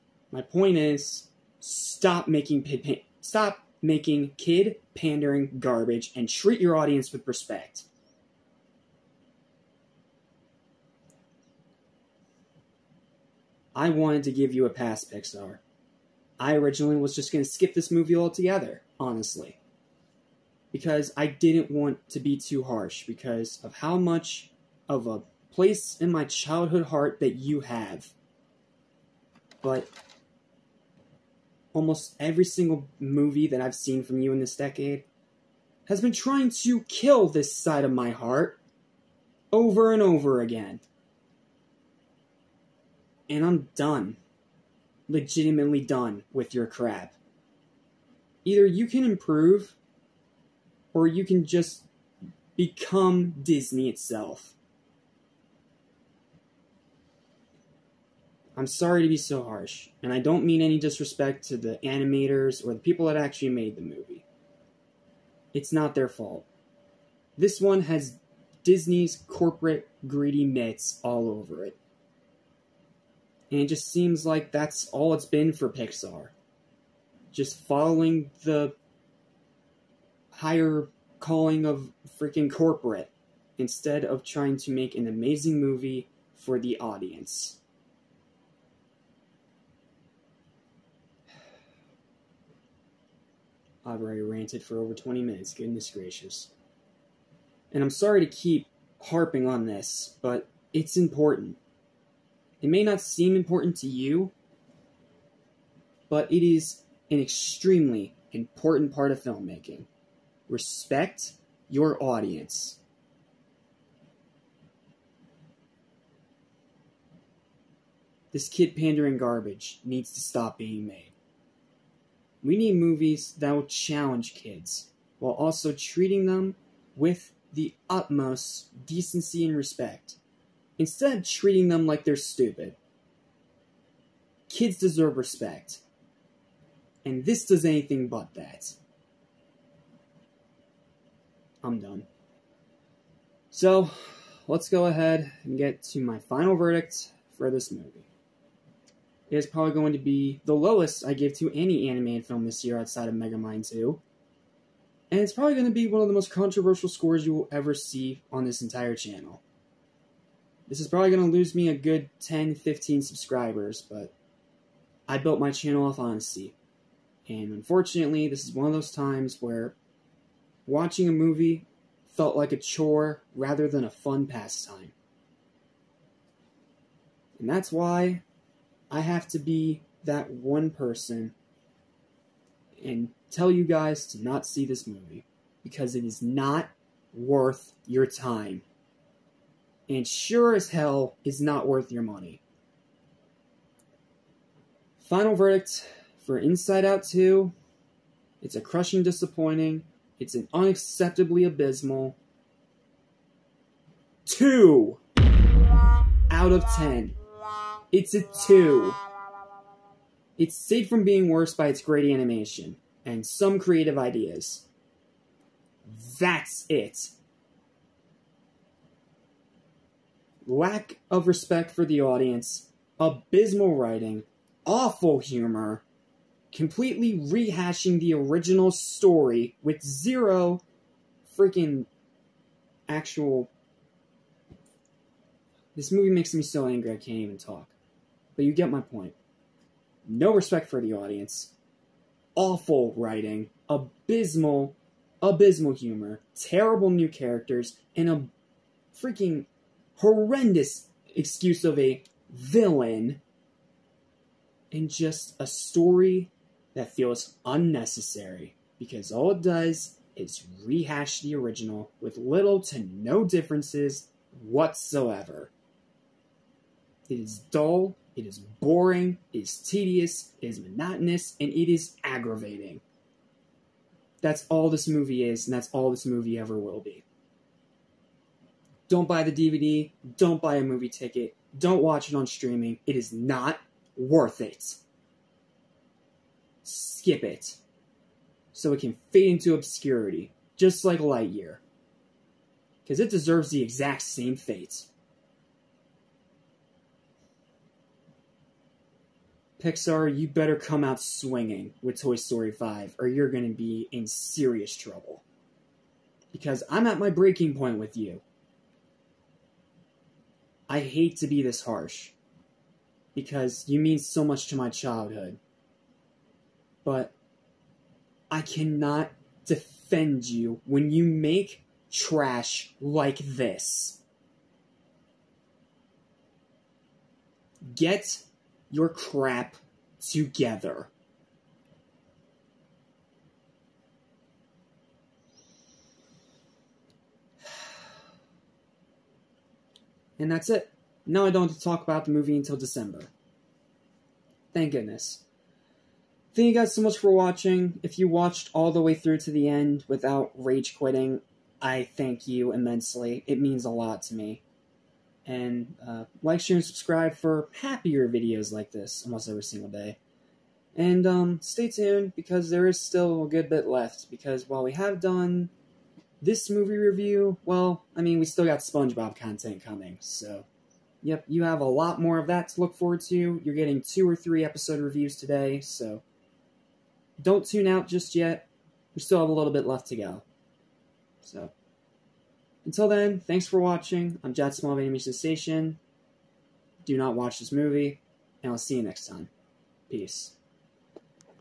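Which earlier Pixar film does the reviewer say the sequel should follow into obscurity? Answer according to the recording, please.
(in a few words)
Lightyear.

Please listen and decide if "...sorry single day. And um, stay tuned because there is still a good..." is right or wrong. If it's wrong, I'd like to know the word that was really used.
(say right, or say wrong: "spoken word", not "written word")
wrong: "every", not "sorry".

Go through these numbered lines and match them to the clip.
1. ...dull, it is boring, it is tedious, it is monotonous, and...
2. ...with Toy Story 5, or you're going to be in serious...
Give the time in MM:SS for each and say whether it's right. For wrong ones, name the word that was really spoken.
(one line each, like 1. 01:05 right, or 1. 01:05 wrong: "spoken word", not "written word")
1. 04:27 right
2. 05:01 right.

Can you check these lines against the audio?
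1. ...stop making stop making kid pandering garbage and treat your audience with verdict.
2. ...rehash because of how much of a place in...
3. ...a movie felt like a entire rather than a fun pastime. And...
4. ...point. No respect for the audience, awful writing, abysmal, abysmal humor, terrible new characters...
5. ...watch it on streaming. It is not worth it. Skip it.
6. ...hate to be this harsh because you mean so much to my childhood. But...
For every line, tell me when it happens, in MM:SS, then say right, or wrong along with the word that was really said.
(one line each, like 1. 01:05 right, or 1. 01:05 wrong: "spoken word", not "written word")
1. 00:01 wrong: "respect", not "verdict"
2. 00:22 wrong: "harsh", not "rehash"
3. 02:51 wrong: "chore", not "entire"
4. 03:58 right
5. 04:41 right
6. 05:10 right.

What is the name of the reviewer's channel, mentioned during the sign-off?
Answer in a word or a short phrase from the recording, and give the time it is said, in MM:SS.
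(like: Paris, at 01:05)
Animation Station, at 06:24.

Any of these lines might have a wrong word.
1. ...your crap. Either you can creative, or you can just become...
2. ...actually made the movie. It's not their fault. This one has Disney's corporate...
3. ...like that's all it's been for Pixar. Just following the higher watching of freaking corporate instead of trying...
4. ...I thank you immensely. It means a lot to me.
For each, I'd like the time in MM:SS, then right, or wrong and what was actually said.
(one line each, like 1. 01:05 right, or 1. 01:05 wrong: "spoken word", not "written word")
1. 00:46 wrong: "improve", not "creative"
2. 01:03 right
3. 01:14 wrong: "calling", not "watching"
4. 05:51 right.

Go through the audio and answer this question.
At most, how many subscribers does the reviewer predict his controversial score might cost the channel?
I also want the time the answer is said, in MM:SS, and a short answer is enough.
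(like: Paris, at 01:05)
15, at 02:42.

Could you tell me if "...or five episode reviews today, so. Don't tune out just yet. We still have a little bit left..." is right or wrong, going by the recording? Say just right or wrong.
wrong.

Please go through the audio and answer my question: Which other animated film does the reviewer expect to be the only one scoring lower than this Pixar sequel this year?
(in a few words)
Megamind 2.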